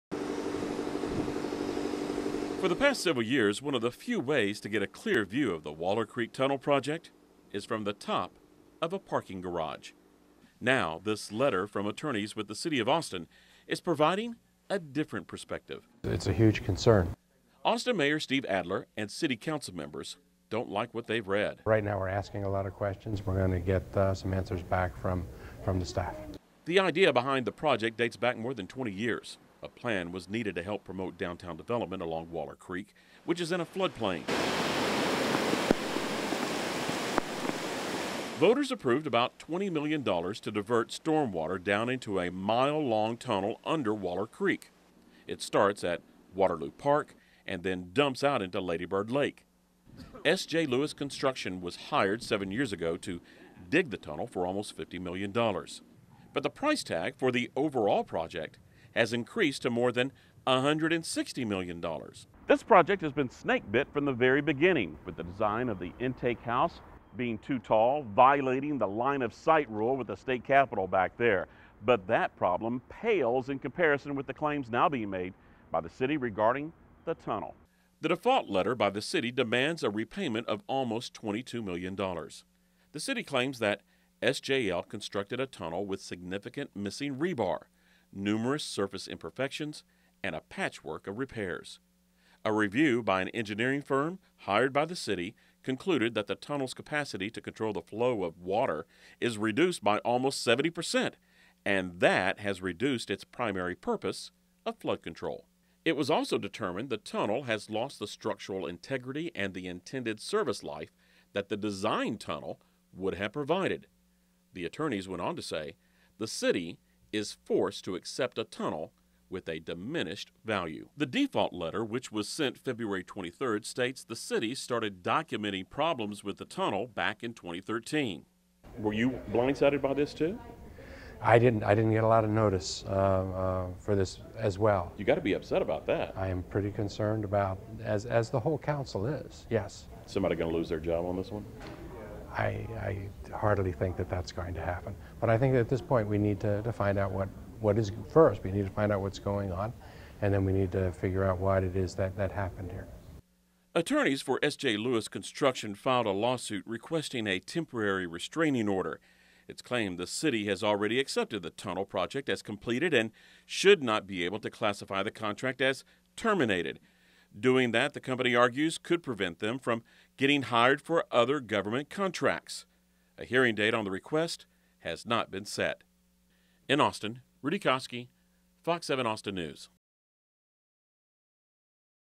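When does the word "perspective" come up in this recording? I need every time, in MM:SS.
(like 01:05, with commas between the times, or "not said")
00:15.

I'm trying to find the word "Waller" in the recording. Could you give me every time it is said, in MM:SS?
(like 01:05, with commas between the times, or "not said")
00:05, 00:32, 00:43.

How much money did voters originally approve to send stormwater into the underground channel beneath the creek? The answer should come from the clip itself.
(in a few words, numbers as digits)
$20 million.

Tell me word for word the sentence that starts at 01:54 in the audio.
The attorneys went on to say the city is forced to accept a tunnel with a diminished value.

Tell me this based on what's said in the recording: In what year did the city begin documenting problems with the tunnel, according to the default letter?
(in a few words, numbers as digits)
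2013.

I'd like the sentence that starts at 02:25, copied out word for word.
But I think at this point we need to, to find out what, what is first.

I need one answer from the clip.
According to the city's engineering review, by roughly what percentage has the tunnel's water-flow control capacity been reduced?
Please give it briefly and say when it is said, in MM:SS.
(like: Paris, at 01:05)
70%, at 01:40.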